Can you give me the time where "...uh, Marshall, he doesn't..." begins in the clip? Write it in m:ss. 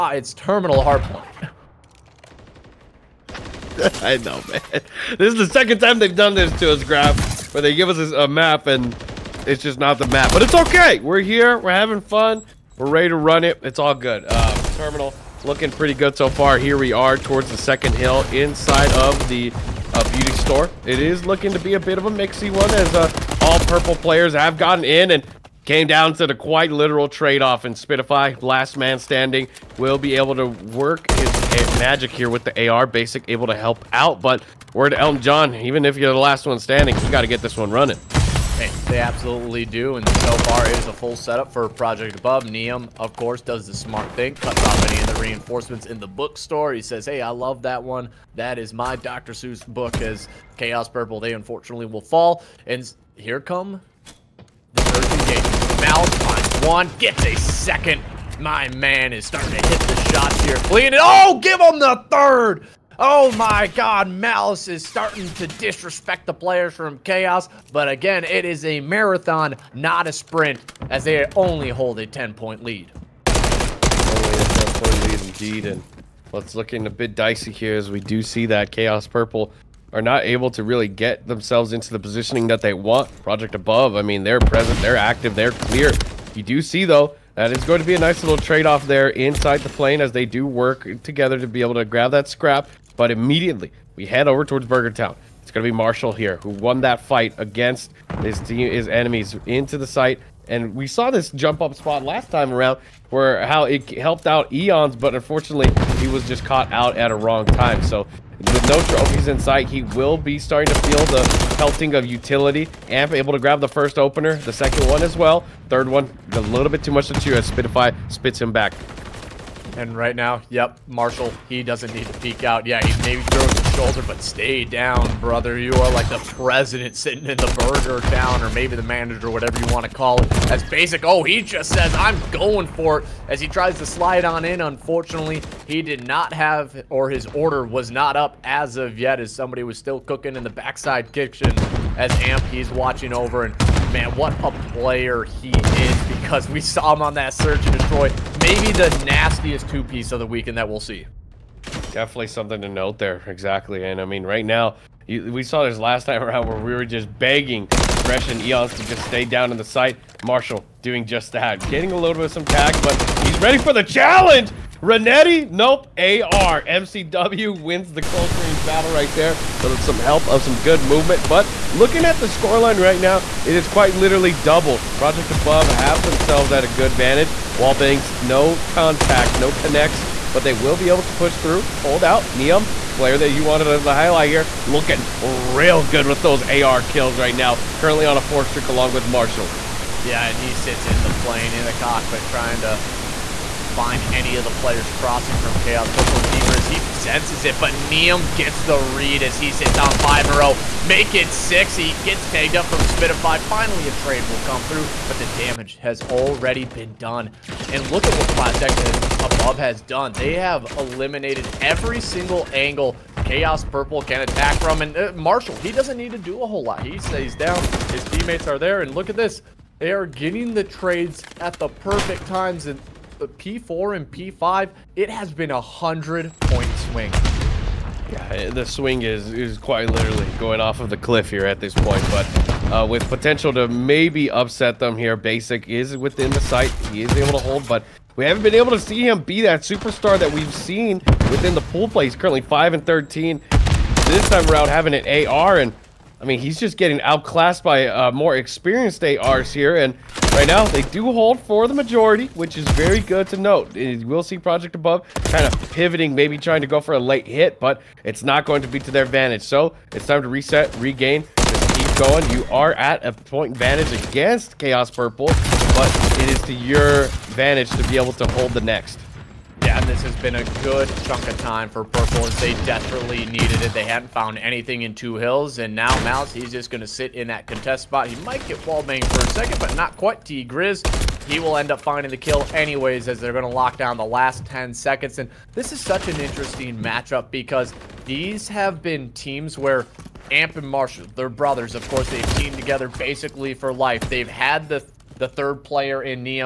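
3:34.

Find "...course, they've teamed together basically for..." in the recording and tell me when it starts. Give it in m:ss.
4:51.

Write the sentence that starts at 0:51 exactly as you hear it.
They unfortunately will fall, and here come the third engagement.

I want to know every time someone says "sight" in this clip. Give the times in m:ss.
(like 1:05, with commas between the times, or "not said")
1:49, 3:56.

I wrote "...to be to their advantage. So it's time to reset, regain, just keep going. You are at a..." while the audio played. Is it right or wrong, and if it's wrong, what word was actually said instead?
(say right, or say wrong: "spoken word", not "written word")
right.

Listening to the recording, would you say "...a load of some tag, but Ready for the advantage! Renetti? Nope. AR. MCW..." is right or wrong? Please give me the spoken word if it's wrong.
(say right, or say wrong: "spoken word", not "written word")
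wrong: "challenge", not "advantage".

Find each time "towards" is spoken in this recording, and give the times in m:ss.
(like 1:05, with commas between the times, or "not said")
0:17, 1:34.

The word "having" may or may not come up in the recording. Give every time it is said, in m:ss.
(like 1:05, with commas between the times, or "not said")
0:11, 4:04.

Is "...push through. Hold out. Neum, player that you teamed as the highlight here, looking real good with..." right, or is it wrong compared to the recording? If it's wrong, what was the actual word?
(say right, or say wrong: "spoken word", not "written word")
wrong: "wanted", not "teamed".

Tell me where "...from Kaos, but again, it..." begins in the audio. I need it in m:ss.
1:06.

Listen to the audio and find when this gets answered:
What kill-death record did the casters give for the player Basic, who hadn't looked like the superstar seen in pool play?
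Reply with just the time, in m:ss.
4:02.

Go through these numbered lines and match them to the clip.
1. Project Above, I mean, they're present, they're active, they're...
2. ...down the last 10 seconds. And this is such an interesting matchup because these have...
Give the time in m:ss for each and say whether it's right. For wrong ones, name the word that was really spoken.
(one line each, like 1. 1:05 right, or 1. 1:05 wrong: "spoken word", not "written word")
1. 1:23 right
2. 4:43 right.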